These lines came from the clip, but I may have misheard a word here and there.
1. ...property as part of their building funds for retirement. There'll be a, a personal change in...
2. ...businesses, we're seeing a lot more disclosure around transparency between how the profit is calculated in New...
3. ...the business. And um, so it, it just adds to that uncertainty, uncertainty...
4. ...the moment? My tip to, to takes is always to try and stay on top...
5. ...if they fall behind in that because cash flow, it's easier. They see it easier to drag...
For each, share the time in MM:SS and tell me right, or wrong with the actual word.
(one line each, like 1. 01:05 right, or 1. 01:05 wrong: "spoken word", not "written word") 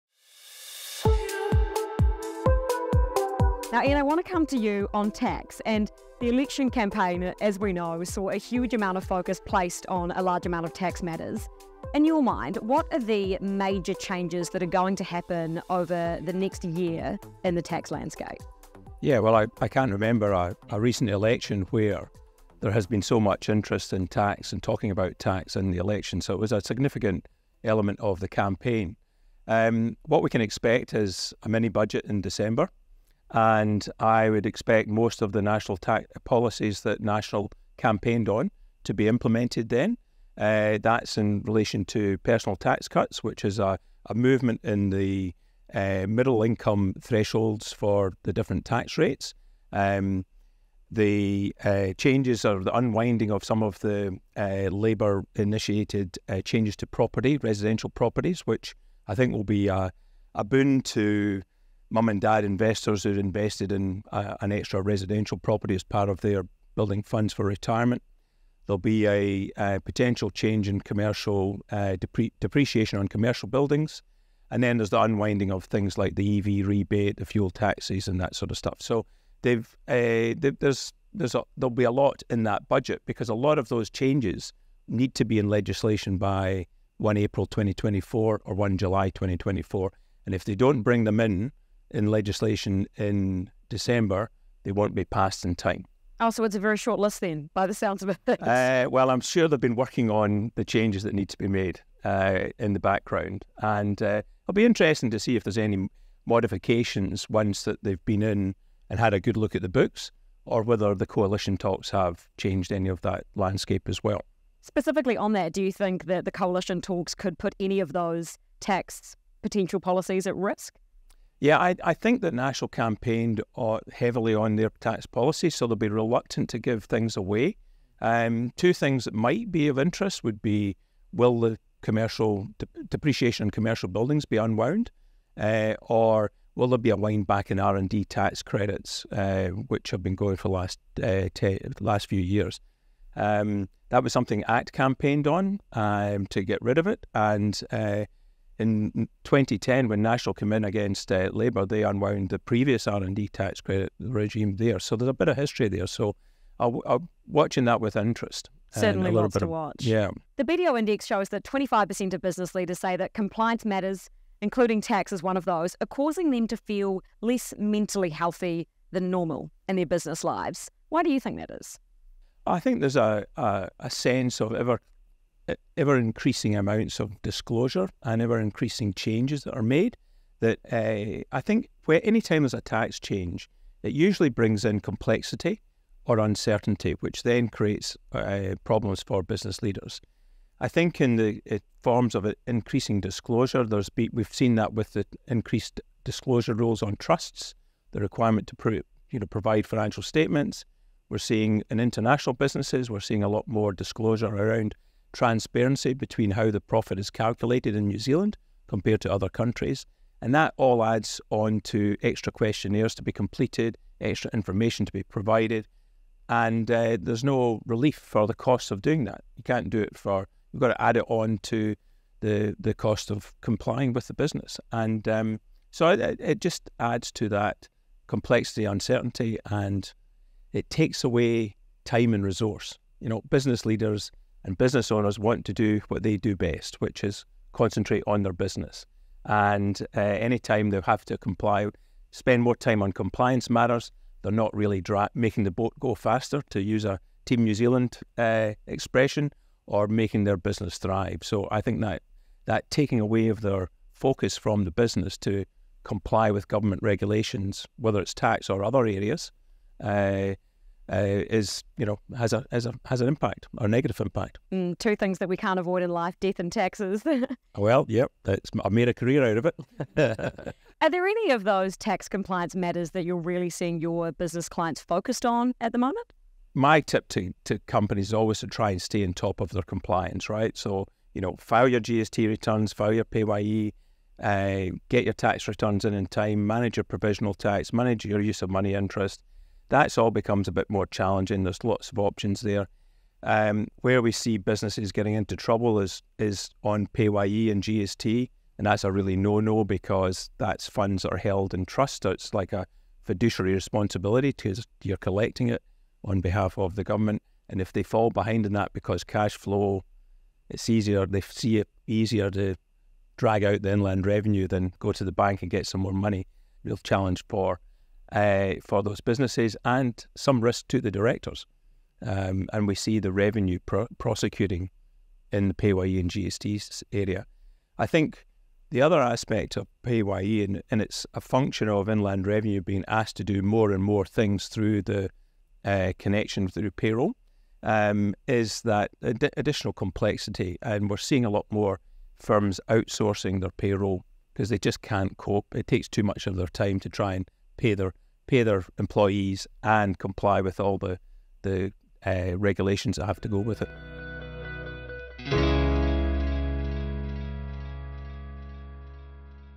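1. 01:05 wrong: "potential", not "personal"
2. 03:22 right
3. 03:44 wrong: "complexity", not "uncertainty"
4. 04:35 wrong: "companies", not "takes"
5. 05:07 right.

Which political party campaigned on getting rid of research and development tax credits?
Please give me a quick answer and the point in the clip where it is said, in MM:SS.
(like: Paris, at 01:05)
ACT, at 02:24.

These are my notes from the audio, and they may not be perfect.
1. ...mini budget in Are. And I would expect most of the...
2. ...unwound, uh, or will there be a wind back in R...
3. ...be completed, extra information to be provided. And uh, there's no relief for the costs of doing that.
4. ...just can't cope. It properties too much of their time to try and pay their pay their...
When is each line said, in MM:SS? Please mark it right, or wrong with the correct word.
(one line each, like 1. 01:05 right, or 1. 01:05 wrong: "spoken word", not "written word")
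1. 00:31 wrong: "December", not "Are"
2. 02:14 right
3. 03:33 right
4. 05:44 wrong: "takes", not "properties".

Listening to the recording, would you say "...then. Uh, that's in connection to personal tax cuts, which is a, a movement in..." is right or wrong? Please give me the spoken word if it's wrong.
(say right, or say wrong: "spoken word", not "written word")
wrong: "relation", not "connection".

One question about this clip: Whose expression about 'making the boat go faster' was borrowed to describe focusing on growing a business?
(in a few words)
Team New Zealand.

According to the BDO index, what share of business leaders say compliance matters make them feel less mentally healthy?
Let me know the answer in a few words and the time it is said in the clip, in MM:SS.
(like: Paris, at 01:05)
25%, at 02:41.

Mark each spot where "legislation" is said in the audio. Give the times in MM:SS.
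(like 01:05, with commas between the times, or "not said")
01:25, 01:32.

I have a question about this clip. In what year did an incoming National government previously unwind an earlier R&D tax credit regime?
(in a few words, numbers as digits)
2010.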